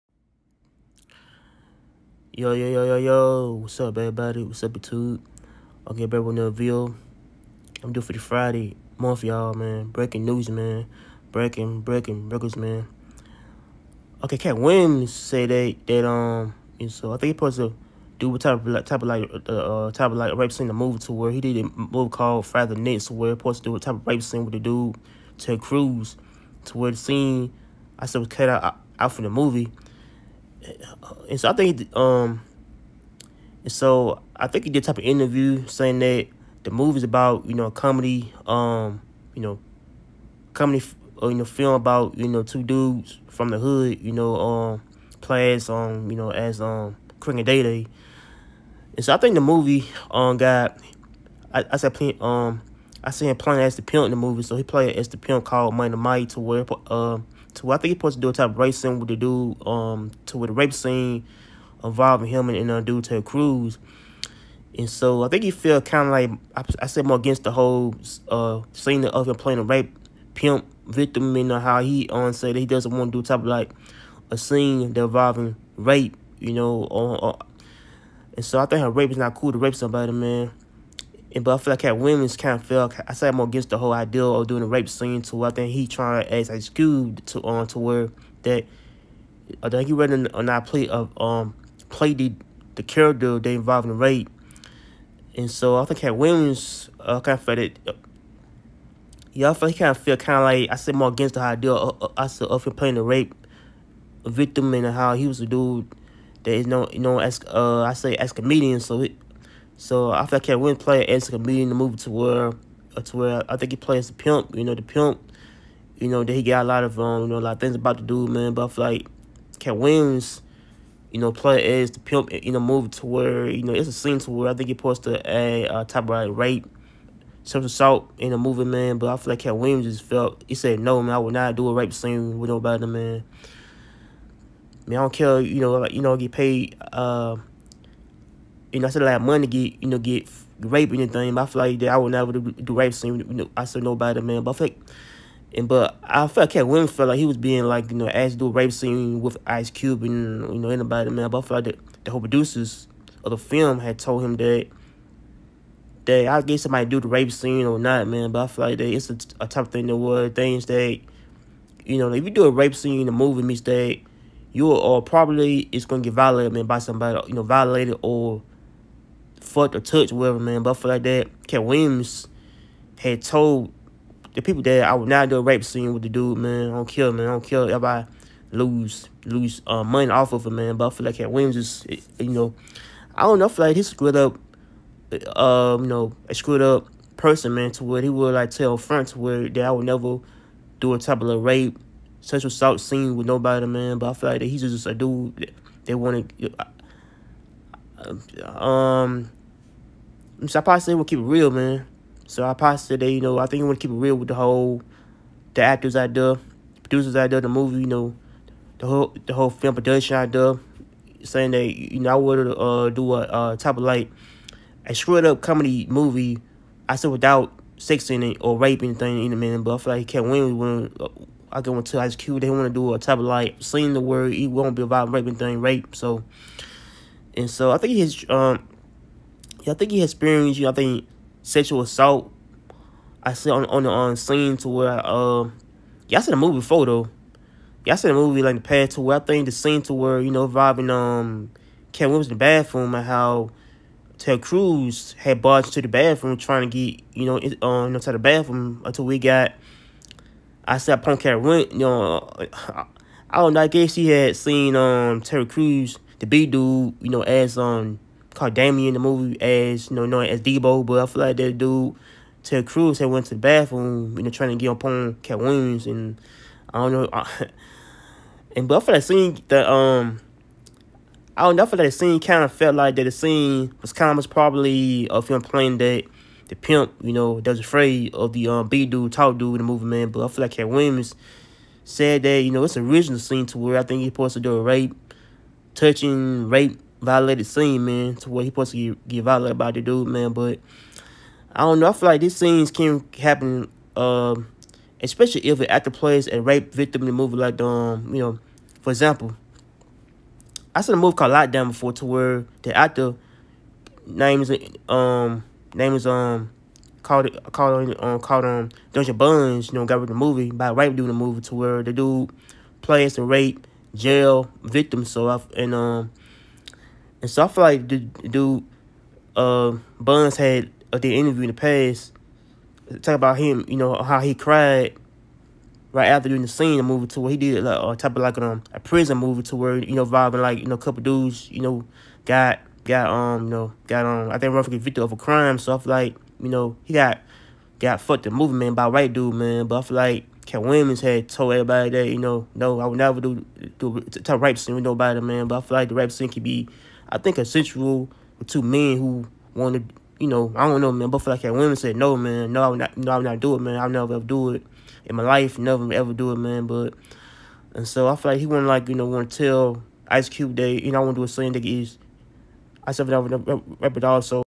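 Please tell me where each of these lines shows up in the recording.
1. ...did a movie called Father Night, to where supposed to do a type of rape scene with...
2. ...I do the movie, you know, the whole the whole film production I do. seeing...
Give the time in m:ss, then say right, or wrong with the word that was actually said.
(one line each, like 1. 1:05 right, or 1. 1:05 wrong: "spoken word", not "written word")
1. 0:21 right
2. 3:27 wrong: "saying", not "seeing".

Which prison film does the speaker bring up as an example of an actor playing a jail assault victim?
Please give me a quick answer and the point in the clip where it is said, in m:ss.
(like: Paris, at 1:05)
Lockdown, at 5:01.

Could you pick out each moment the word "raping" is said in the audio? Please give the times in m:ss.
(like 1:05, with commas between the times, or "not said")
3:45.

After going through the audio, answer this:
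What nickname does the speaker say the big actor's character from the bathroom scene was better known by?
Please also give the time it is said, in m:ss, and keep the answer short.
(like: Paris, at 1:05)
Debo, at 4:20.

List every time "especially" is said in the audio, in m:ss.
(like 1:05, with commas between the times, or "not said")
4:55.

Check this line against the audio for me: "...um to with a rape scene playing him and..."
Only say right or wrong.
wrong.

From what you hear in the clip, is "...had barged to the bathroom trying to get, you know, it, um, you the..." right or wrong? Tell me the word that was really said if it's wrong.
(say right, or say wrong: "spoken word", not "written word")
right.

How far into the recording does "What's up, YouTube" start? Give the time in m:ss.
0:04.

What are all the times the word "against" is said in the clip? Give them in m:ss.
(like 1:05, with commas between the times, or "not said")
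1:07, 1:23, 1:41.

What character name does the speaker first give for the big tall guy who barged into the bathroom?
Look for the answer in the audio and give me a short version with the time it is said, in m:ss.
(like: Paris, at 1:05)
Damien, at 4:18.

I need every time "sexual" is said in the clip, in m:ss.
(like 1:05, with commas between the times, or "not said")
2:07, 3:12, 3:51.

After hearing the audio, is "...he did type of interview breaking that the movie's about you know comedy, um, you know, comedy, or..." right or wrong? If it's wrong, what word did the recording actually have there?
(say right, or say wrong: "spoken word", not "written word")
wrong: "saying", not "breaking".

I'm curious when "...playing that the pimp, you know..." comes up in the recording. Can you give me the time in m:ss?
4:35.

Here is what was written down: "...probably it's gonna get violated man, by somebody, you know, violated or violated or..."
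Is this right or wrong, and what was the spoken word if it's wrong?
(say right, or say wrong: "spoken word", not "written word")
wrong: "fucked", not "violated".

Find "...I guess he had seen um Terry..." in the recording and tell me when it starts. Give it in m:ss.
4:13.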